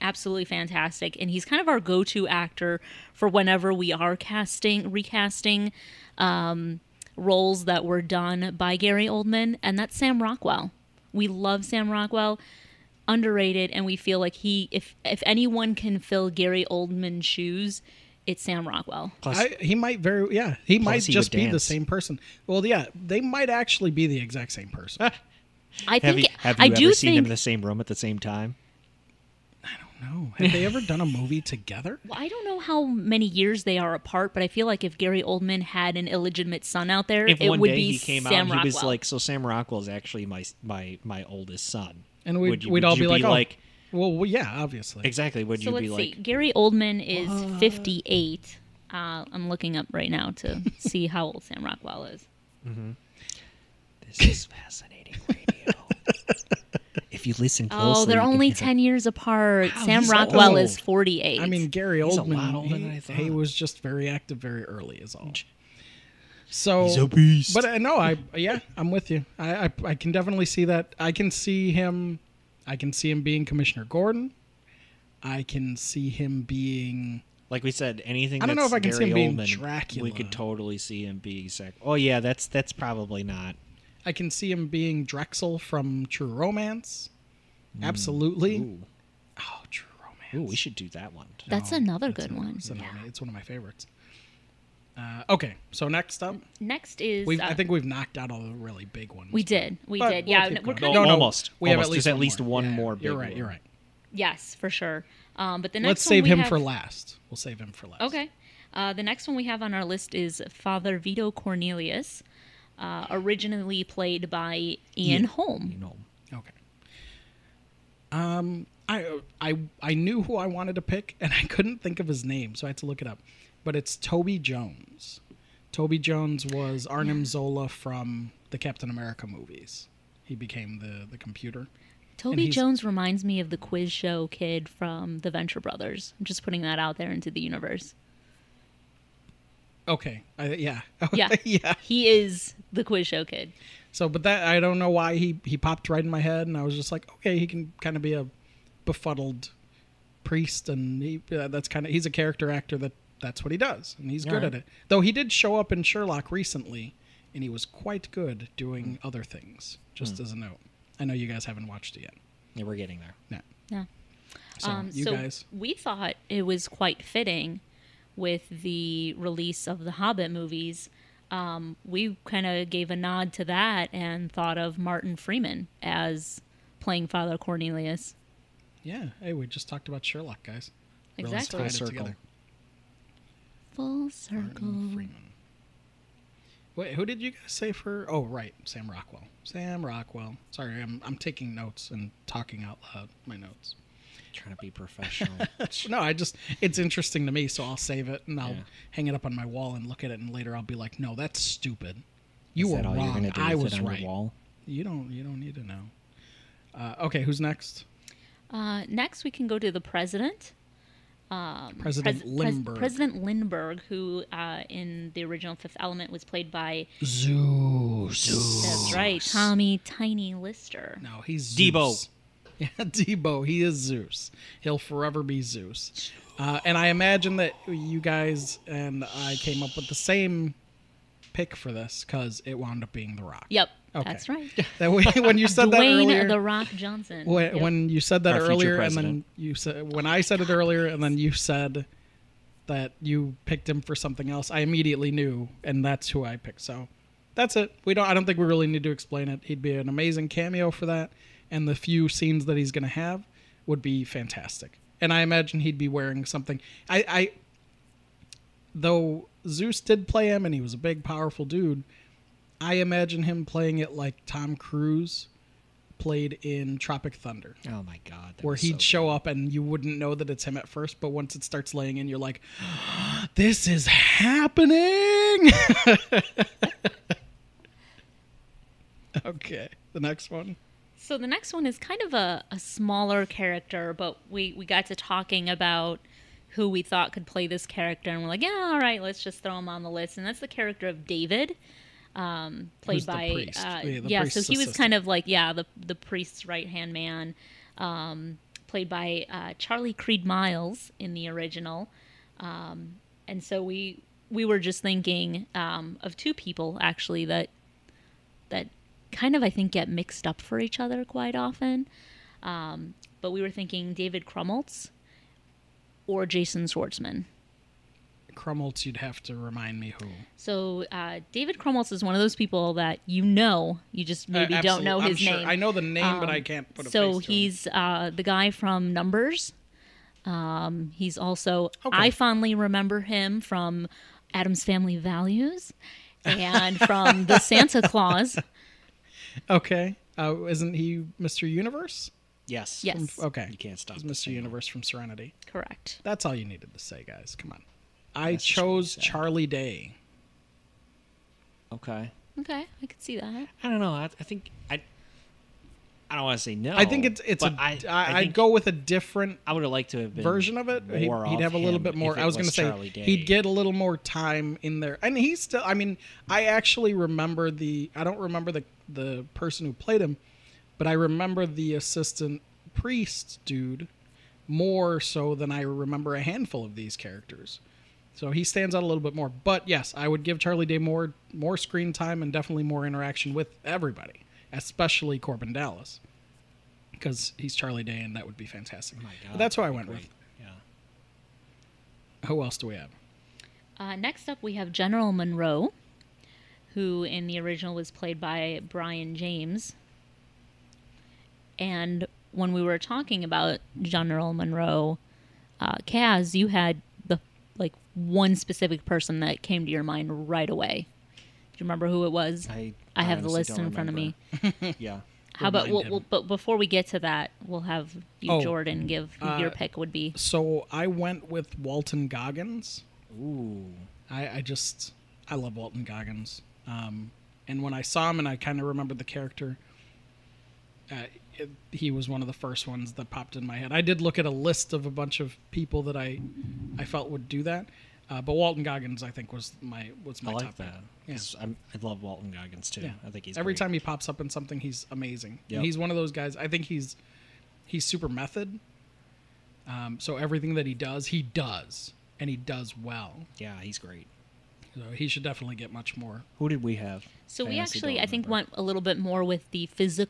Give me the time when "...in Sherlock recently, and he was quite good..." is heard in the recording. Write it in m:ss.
2:35.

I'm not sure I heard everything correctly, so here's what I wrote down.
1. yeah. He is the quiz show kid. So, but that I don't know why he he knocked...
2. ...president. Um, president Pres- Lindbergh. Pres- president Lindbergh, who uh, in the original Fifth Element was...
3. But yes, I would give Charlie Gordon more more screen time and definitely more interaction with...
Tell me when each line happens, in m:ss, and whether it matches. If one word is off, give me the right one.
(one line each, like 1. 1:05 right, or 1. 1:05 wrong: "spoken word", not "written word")
1. 2:21 wrong: "popped", not "knocked"
2. 3:29 right
3. 6:19 wrong: "Day", not "Gordon".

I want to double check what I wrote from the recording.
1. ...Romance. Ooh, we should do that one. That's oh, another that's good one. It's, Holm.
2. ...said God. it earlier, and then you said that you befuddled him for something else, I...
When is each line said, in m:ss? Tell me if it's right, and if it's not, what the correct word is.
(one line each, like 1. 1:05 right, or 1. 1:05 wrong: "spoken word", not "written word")
1. 1:30 wrong: "Yeah", not "Holm"
2. 4:00 wrong: "picked", not "befuddled".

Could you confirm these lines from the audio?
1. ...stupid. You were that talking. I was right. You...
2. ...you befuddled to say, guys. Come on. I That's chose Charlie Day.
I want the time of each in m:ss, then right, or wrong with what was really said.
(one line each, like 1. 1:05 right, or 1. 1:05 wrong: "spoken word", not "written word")
1. 3:21 wrong: "wrong", not "talking"
2. 5:46 wrong: "needed", not "befuddled".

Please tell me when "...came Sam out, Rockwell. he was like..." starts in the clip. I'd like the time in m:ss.
0:37.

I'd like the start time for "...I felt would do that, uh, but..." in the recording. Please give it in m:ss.
7:16.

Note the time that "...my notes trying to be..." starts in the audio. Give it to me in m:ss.
3:13.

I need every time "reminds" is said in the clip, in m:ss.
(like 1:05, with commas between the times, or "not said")
2:12, 5:19.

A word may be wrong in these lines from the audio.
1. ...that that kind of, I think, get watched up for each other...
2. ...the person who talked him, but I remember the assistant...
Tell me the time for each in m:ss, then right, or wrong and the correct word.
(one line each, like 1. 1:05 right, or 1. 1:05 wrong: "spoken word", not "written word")
1. 5:07 wrong: "mixed", not "watched"
2. 6:08 wrong: "played", not "talked".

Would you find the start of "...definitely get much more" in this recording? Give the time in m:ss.
7:35.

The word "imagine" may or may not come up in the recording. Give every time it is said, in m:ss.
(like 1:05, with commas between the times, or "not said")
3:46, 4:15, 4:22.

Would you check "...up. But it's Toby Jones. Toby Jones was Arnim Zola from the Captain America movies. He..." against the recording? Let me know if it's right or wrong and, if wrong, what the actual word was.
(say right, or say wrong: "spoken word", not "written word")
right.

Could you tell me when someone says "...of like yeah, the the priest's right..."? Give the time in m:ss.
4:54.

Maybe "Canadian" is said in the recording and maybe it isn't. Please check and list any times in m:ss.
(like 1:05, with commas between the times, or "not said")
not said.